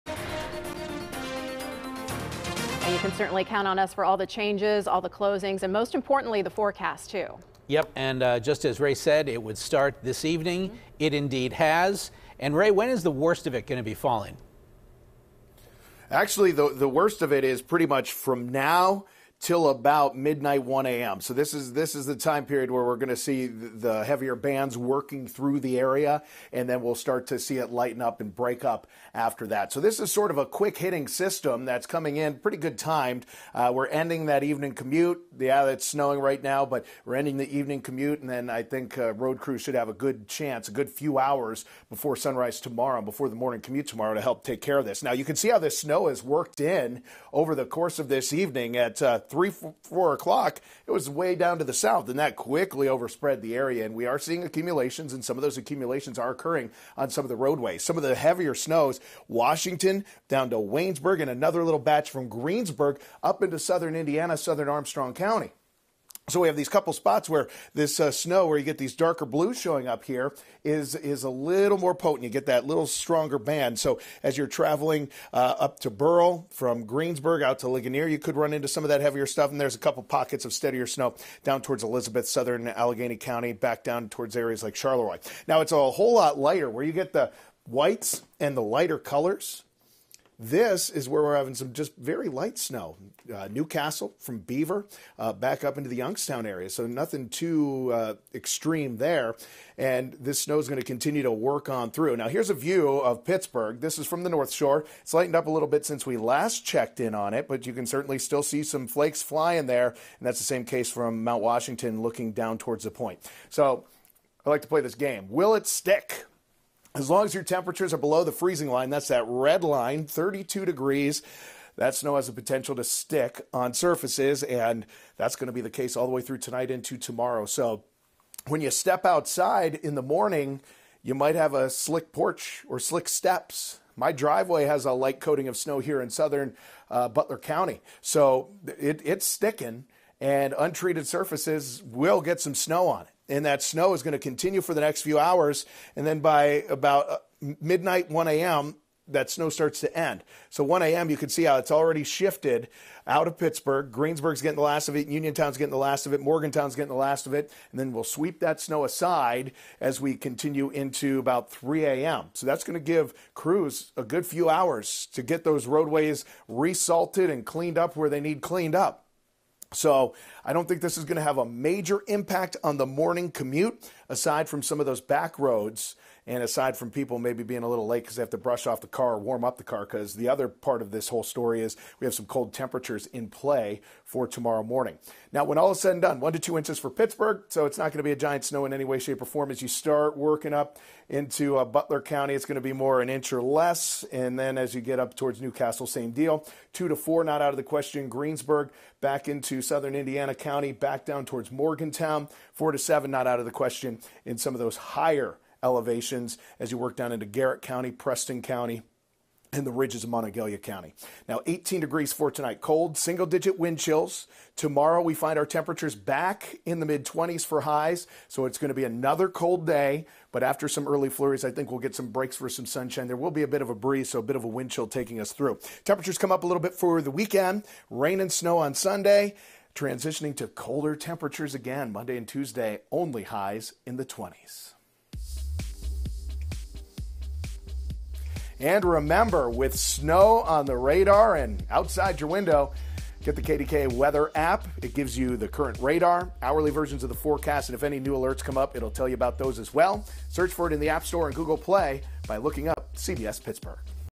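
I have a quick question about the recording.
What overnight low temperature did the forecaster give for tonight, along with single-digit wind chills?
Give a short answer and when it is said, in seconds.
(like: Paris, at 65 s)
18 degrees, at 211 s.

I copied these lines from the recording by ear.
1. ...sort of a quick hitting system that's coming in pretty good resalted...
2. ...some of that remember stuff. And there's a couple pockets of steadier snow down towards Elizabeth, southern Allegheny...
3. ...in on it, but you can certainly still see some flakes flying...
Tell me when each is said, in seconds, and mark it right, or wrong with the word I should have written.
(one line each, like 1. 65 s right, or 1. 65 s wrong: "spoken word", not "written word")
1. 30 s wrong: "timed", not "resalted"
2. 78 s wrong: "heavier", not "remember"
3. 106 s right.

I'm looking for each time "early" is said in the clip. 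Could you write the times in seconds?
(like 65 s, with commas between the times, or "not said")
220 s.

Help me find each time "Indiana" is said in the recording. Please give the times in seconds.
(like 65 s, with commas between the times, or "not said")
63 s, 199 s.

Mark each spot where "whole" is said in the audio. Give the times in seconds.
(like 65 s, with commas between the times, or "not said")
85 s, 181 s.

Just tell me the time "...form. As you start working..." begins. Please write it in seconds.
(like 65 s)
189 s.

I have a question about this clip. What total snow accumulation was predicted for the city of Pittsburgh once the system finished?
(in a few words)
1 to 2 inches.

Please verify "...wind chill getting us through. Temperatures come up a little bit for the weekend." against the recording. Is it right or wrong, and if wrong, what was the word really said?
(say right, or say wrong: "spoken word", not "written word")
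wrong: "taking", not "getting".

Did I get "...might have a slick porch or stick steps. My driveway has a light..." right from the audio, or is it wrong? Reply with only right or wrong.
wrong.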